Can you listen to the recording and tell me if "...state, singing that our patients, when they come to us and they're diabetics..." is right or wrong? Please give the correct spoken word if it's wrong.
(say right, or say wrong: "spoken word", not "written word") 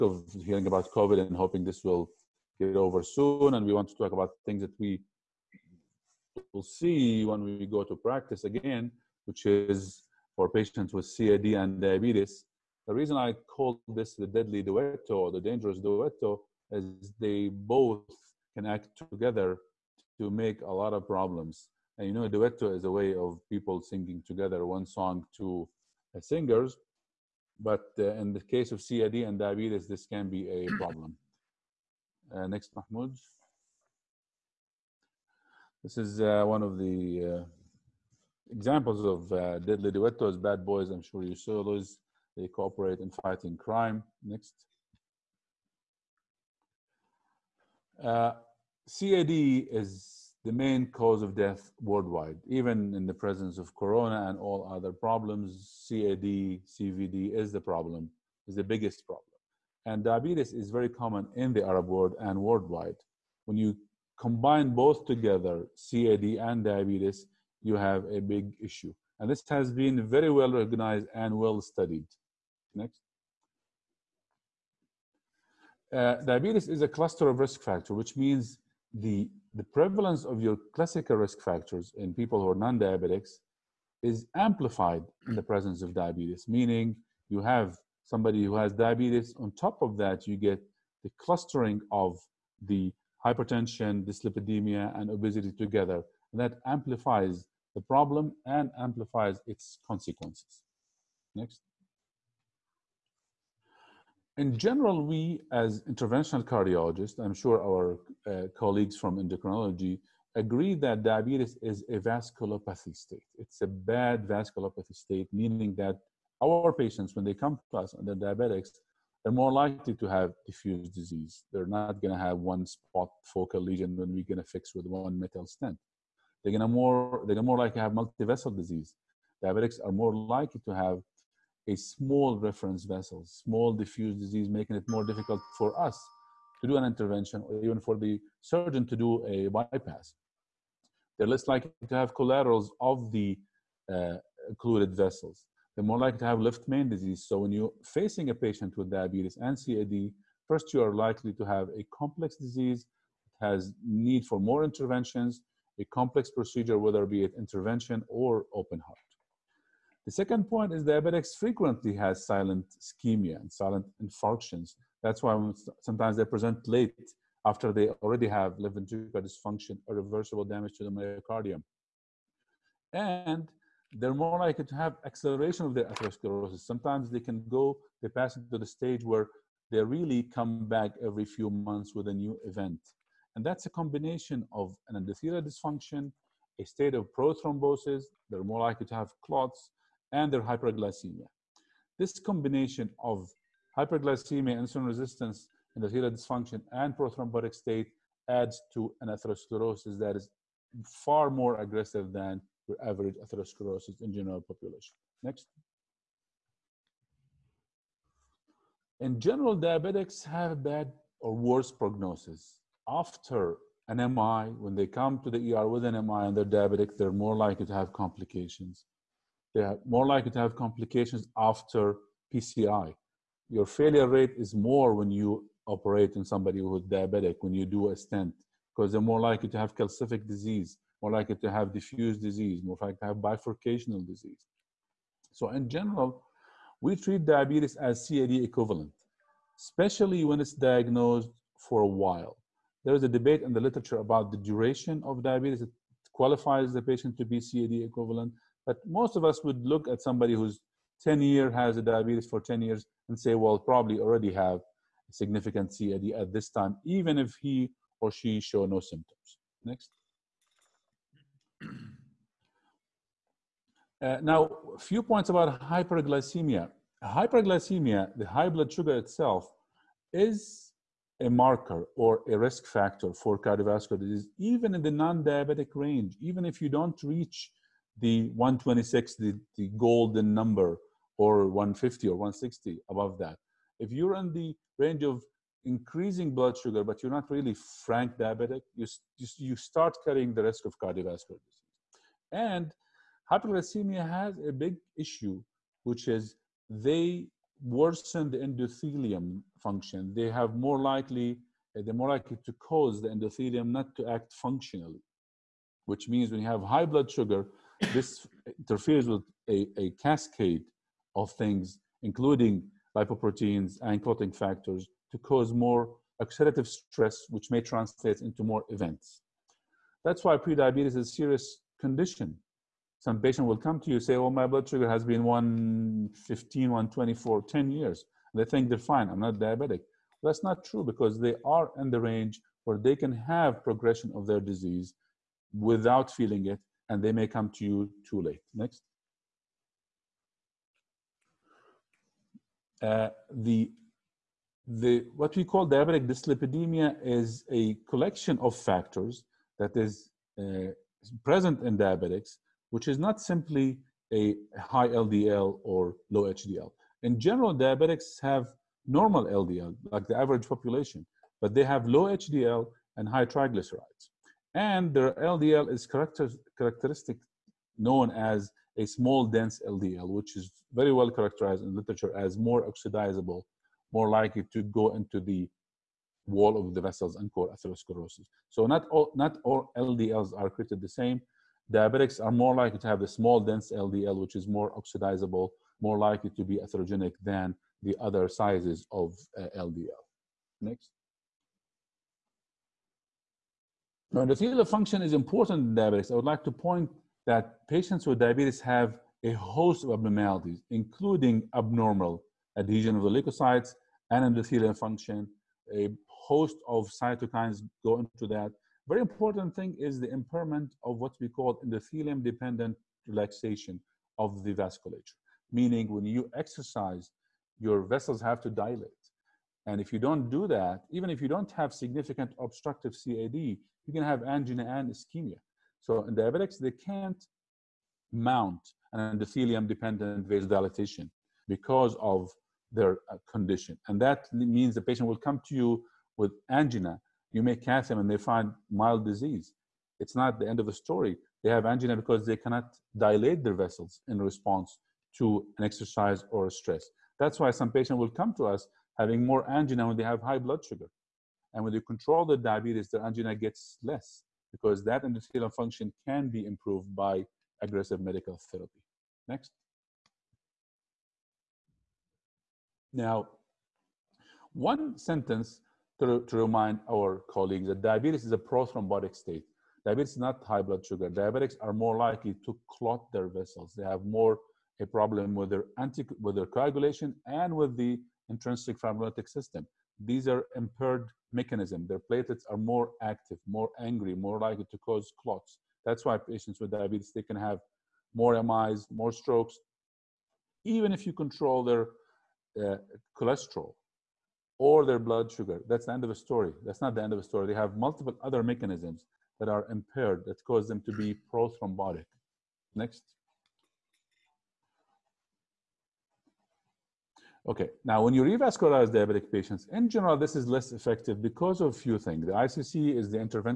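wrong: "meaning", not "singing".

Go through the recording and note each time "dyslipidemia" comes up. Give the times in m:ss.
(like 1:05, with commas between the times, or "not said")
1:34, 5:46.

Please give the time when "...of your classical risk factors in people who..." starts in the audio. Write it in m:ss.
1:20.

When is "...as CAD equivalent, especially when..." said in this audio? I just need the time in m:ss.
3:57.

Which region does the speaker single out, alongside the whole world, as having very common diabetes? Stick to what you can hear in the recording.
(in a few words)
the Arab world.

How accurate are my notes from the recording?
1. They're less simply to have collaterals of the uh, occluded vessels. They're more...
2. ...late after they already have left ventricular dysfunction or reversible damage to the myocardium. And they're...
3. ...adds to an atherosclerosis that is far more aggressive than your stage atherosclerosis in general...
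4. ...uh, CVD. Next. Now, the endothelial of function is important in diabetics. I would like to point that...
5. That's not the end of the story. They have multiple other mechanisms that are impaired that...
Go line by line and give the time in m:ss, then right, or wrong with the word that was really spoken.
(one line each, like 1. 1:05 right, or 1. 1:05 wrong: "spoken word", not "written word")
1. 2:21 wrong: "likely", not "simply"
2. 2:46 right
3. 3:18 wrong: "average", not "stage"
4. 6:29 wrong: "LDL", not "CVD"
5. 8:16 right.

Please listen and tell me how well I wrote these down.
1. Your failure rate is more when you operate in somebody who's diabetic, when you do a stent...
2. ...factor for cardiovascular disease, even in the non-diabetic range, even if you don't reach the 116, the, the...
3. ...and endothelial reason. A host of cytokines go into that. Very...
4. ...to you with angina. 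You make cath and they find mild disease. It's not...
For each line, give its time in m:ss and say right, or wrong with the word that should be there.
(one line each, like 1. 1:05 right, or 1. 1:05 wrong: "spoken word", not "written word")
1. 3:43 right
2. 4:32 wrong: "126", not "116"
3. 6:44 wrong: "function", not "reason"
4. 7:15 right.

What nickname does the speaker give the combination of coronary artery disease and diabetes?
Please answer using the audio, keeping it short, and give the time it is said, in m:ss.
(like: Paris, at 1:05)
deadly duetto, at 0:14.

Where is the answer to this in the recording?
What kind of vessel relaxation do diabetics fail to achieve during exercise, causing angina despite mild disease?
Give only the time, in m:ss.
7:09.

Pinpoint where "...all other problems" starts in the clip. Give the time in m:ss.
0:54.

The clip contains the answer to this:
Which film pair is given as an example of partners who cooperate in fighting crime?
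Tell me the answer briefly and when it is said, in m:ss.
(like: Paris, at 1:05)
Bad Boys, at 0:40.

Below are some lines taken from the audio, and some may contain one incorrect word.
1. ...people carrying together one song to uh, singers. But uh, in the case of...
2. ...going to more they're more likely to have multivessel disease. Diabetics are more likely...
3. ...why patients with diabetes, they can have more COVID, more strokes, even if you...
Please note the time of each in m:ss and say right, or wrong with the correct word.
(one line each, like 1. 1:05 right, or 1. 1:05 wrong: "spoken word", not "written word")
1. 0:23 wrong: "singing", not "carrying"
2. 2:06 right
3. 8:06 wrong: "MIs", not "COVID".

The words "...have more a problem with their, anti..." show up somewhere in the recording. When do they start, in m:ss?
7:53.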